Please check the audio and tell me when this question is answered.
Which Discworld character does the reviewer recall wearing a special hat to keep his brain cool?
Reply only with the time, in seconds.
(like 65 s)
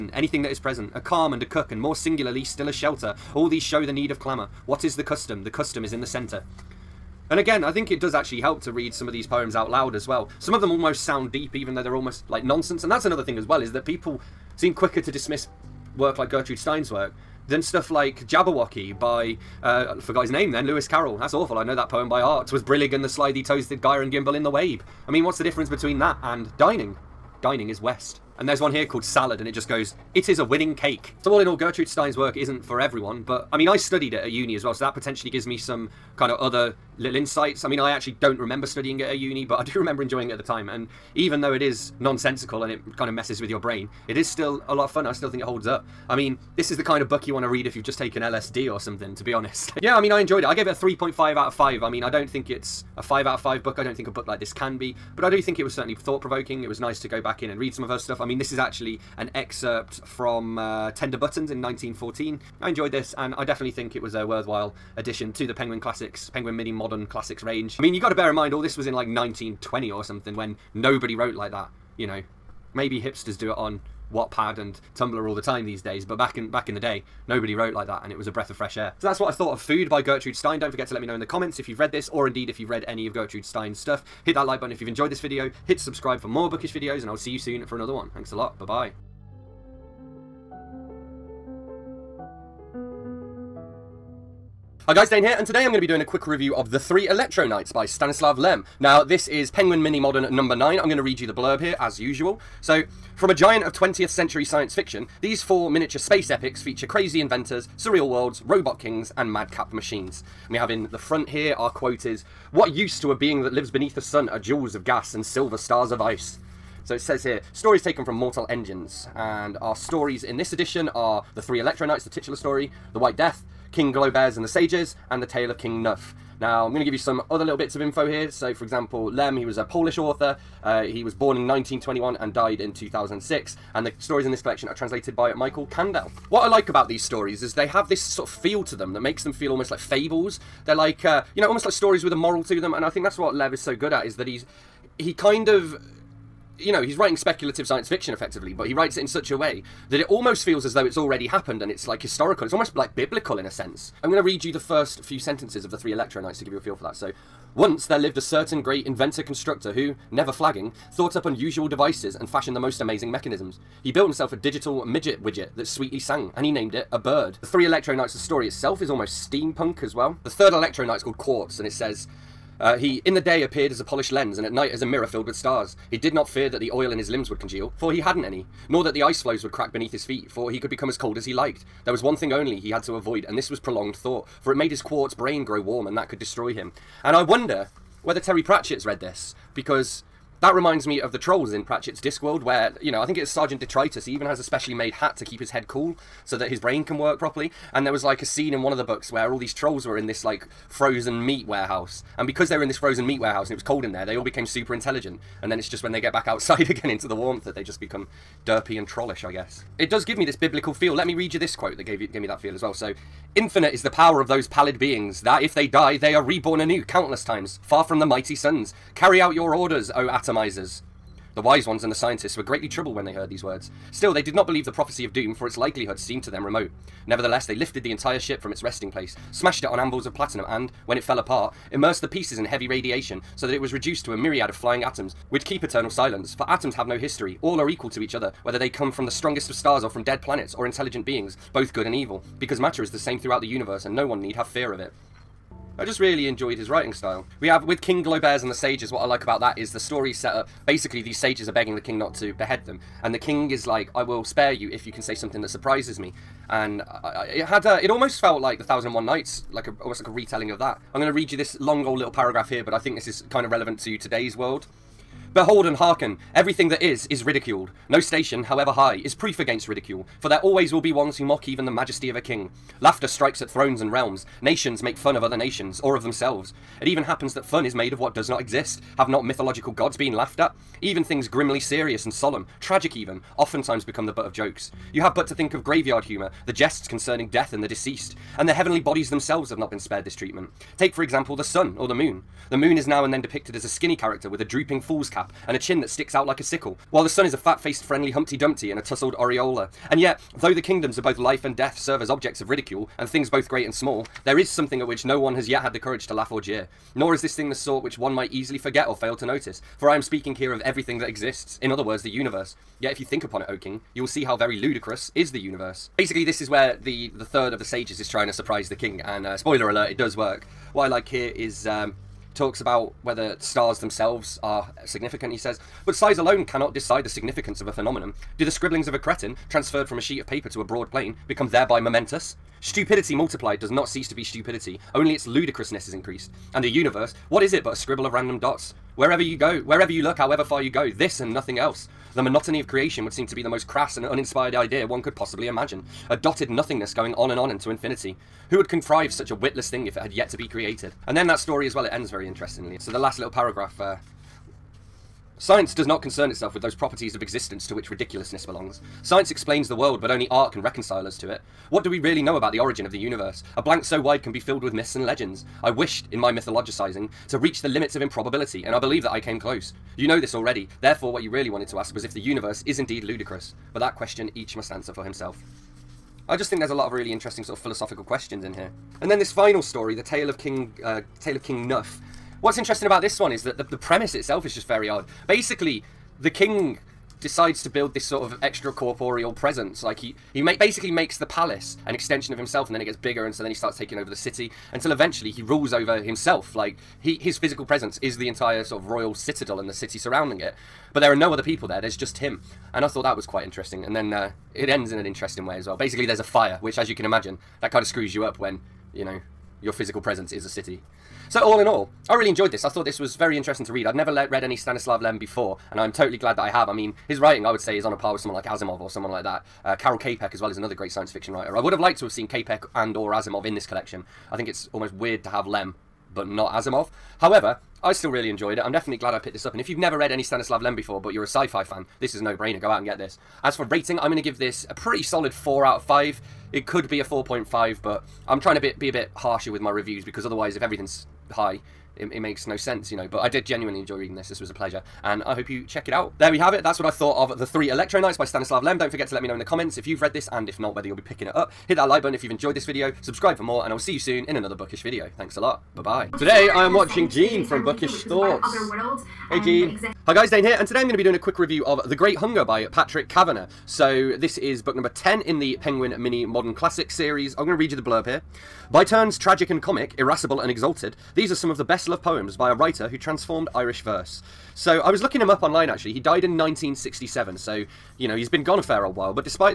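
193 s.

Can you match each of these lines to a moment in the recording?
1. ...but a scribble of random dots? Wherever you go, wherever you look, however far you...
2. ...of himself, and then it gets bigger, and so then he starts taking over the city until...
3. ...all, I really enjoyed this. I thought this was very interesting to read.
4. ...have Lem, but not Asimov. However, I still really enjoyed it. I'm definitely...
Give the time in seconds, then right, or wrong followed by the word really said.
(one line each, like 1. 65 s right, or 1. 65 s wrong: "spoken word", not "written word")
1. 337 s right
2. 392 s right
3. 411 s right
4. 425 s right.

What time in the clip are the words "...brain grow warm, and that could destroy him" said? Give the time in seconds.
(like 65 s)
185 s.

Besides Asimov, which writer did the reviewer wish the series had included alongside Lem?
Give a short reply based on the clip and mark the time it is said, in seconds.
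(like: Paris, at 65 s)
Karel Capek, at 419 s.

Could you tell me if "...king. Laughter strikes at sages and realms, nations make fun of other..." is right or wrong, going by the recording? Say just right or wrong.
wrong.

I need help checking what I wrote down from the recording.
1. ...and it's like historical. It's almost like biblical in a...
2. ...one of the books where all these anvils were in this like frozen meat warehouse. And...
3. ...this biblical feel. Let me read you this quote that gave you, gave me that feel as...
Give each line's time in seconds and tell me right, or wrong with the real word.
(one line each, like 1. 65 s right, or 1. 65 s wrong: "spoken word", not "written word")
1. 151 s right
2. 198 s wrong: "trolls", not "anvils"
3. 210 s right.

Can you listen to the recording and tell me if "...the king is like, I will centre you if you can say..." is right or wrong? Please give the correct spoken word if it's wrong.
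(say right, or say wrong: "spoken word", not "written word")
wrong: "spare", not "centre".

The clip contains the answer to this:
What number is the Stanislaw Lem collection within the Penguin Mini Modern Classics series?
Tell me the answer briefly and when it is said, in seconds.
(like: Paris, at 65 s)
9, at 100 s.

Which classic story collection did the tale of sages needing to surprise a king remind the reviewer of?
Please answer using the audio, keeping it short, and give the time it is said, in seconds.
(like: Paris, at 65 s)
The Thousand and One Nights, at 258 s.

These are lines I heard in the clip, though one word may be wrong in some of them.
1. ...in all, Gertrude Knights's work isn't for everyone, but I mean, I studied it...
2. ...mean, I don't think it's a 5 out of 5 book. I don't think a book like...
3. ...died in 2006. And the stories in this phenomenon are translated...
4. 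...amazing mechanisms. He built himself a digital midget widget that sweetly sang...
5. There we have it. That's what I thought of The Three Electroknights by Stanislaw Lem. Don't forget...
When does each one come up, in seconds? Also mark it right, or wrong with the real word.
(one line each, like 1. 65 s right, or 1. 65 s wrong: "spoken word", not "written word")
1. 31 s wrong: "Stein", not "Knights"
2. 51 s right
3. 132 s wrong: "collection", not "phenomenon"
4. 162 s right
5. 446 s right.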